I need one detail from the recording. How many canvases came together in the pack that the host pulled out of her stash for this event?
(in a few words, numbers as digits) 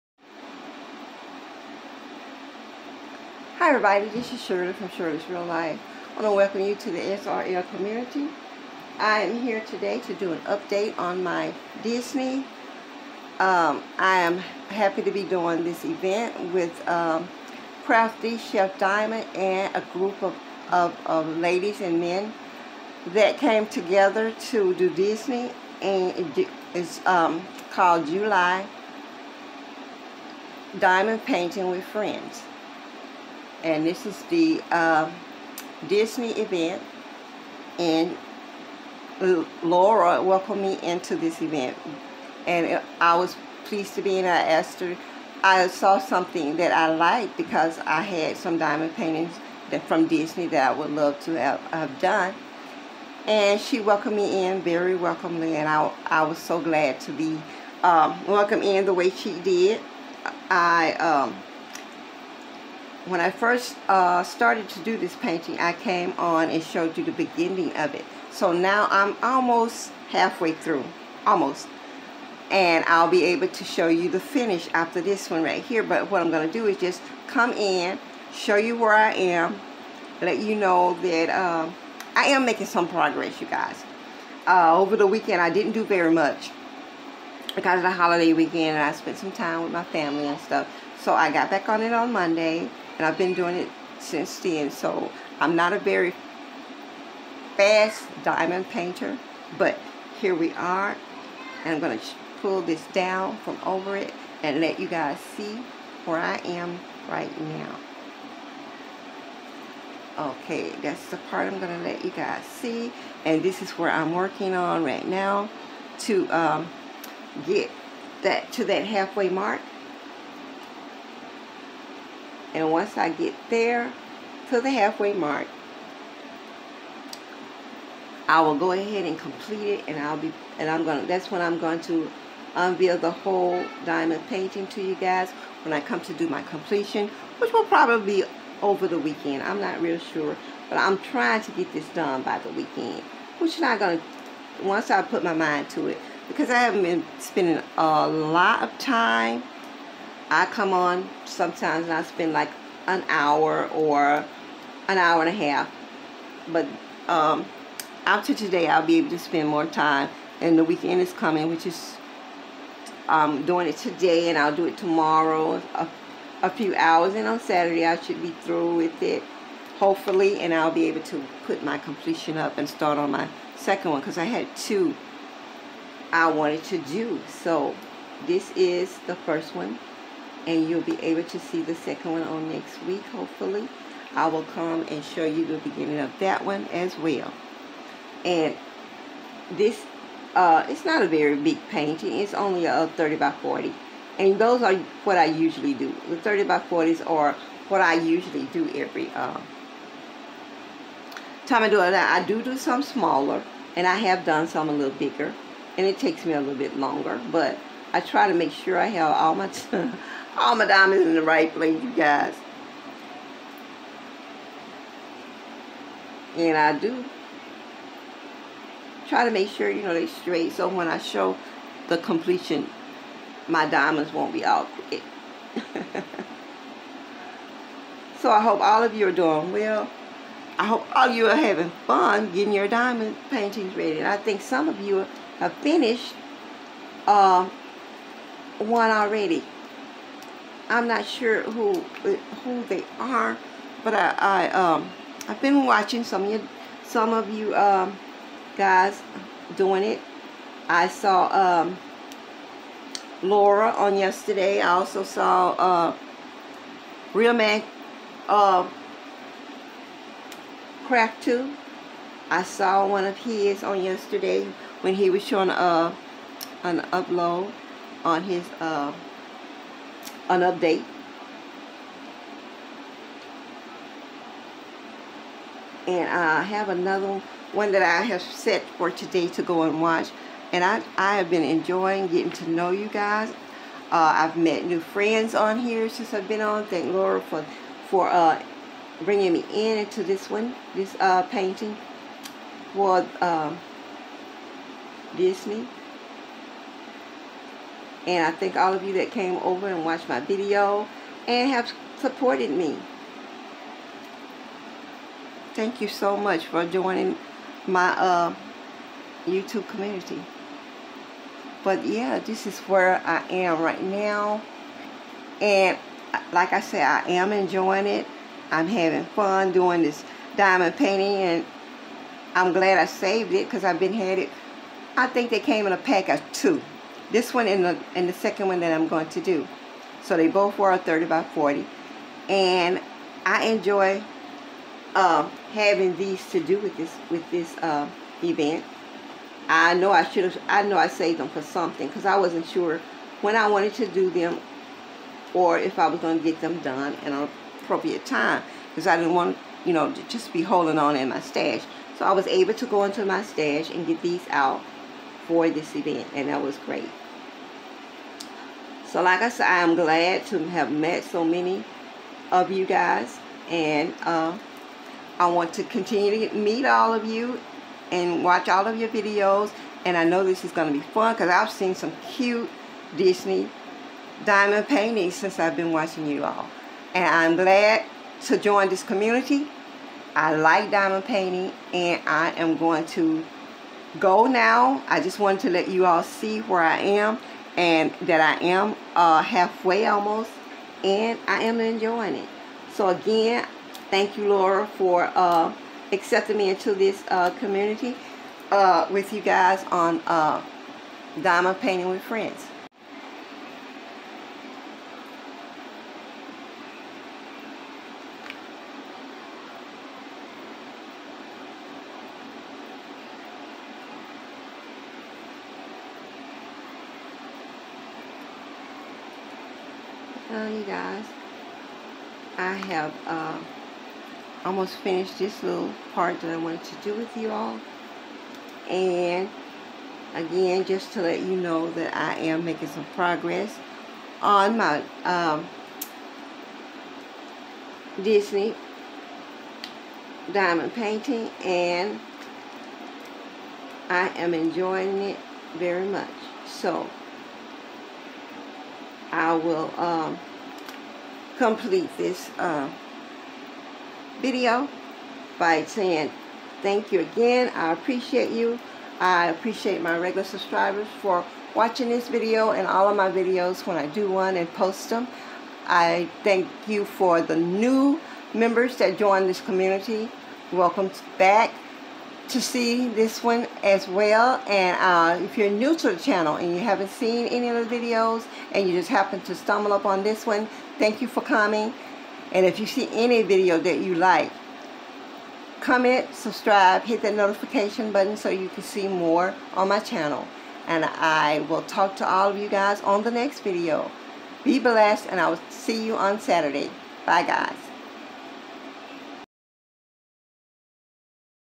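2.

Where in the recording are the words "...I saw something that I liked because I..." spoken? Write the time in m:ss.
0:45.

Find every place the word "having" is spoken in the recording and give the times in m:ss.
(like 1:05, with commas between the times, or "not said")
3:51, 5:18, 5:35.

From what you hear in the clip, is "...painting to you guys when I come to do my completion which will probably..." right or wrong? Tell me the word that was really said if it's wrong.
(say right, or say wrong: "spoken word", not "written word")
right.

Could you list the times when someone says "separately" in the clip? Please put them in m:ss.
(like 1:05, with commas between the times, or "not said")
not said.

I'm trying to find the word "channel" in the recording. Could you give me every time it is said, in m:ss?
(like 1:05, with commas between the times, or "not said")
7:55, 8:09.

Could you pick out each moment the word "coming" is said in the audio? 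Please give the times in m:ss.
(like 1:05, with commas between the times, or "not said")
2:41, 8:01.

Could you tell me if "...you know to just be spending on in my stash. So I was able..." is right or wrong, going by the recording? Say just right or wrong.
wrong.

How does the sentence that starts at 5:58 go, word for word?
So like I said, I'm glad to have met so many of you guys.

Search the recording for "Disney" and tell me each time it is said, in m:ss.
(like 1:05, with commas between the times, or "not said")
0:11, 0:24, 0:35, 0:50, 4:55, 6:12, 7:18.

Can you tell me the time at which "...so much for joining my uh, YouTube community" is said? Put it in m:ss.
5:05.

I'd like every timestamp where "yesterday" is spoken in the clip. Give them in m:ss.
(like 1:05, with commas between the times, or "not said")
4:13, 4:23.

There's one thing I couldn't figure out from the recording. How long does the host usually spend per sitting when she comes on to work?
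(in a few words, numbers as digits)
an hour and a half.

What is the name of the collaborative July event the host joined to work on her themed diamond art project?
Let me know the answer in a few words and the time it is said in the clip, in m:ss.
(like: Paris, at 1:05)
July Diamond Painting with Friends, at 0:28.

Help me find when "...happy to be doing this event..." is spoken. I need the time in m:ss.
0:14.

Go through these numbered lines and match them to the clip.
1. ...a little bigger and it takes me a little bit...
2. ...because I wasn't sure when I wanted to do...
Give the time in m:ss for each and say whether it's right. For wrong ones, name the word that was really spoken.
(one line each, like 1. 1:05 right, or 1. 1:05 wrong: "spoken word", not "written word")
1. 3:24 right
2. 5:41 right.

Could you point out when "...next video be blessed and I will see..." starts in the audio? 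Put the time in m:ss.
8:13.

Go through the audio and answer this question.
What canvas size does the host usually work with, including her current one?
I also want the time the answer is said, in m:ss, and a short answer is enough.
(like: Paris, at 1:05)
30 by 40, at 3:12.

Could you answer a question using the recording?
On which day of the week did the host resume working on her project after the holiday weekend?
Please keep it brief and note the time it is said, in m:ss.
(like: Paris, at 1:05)
Monday, at 1:32.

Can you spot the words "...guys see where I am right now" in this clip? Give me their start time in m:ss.
1:44.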